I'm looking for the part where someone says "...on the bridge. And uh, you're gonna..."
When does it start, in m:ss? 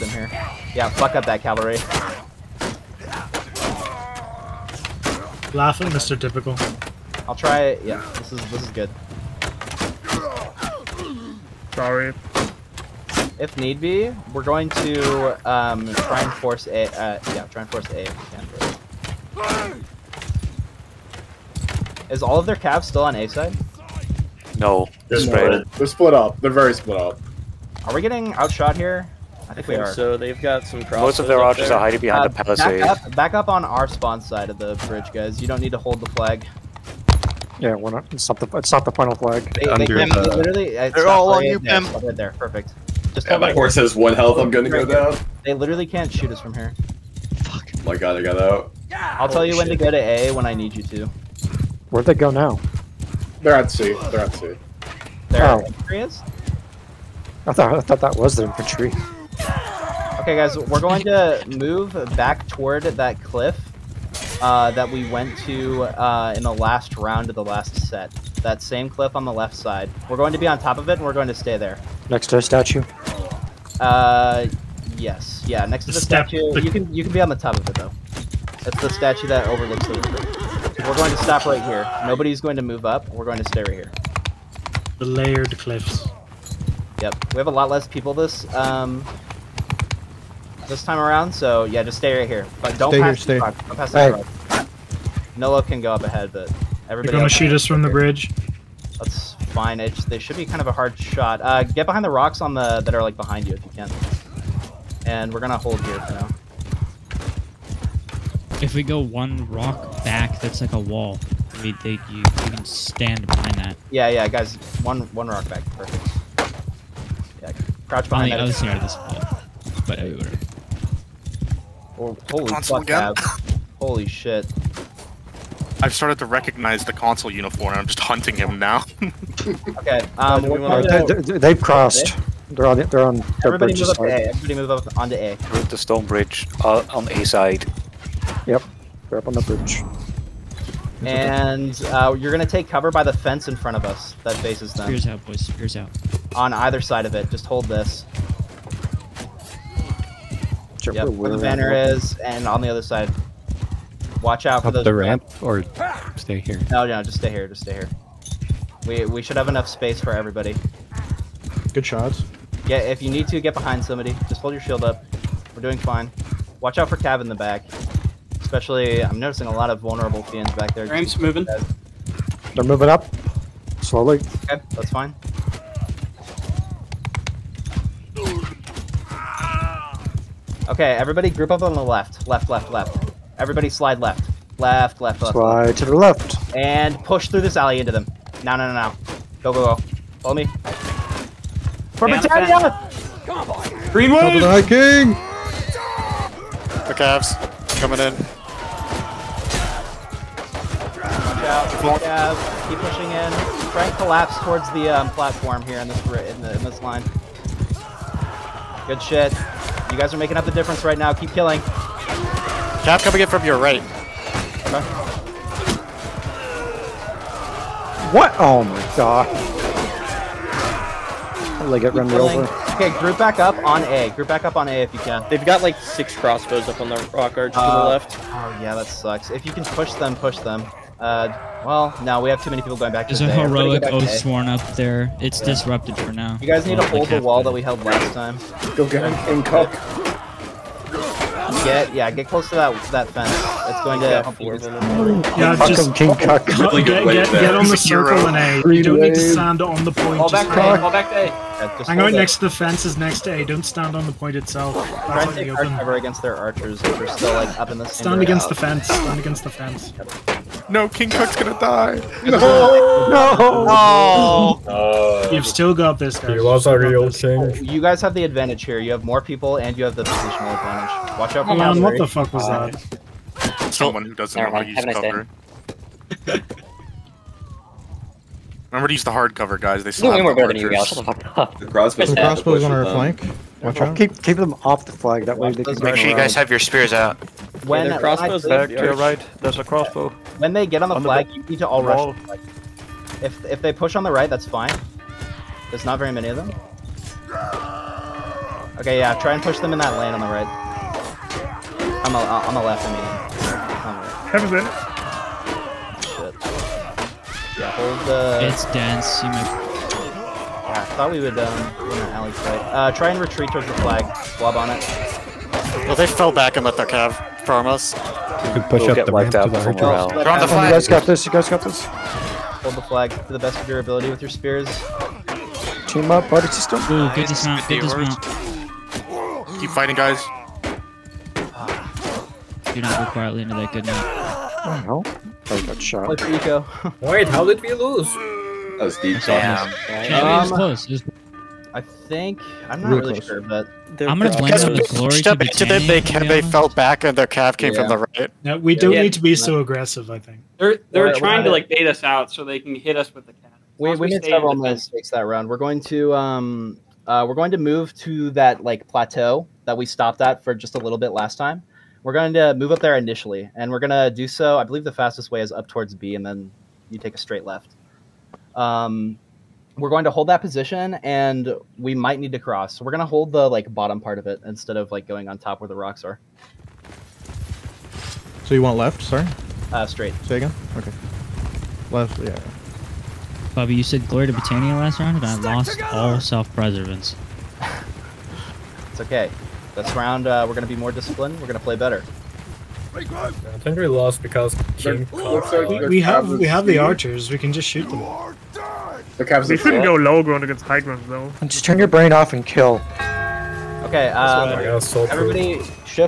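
2:19.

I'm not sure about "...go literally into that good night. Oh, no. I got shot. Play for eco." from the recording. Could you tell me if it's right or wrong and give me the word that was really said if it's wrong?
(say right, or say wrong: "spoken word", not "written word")
wrong: "quietly", not "literally".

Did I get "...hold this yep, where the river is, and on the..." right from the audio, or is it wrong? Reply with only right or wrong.
wrong.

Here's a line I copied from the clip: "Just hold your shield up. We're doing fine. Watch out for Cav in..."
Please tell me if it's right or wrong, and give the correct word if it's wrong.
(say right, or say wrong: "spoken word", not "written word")
right.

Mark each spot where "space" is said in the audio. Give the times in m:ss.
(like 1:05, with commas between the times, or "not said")
2:39.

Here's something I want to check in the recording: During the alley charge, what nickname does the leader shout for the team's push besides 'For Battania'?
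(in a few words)
Green wave.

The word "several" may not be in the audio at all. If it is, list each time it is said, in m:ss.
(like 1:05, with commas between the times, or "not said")
5:54.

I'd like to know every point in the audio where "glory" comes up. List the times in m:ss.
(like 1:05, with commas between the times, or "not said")
5:44, 6:24.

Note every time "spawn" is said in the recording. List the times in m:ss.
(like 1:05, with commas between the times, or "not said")
0:33.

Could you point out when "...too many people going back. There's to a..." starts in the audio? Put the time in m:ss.
3:52.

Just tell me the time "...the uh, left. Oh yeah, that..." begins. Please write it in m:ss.
3:47.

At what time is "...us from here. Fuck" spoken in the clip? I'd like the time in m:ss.
0:46.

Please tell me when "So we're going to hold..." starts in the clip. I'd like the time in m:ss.
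6:12.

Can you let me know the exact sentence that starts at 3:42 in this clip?
Okay, group back up on A.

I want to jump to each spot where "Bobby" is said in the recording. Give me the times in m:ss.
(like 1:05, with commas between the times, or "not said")
6:23.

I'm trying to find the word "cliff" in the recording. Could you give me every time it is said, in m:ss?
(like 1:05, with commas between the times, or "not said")
1:03, 1:08, 1:25.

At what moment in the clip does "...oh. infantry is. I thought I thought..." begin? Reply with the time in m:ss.
0:55.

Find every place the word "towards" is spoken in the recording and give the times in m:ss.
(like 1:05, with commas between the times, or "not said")
1:02, 3:24, 5:13, 6:05.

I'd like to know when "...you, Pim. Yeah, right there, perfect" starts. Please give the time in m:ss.
0:41.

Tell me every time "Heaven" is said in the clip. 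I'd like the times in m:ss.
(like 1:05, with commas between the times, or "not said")
5:04.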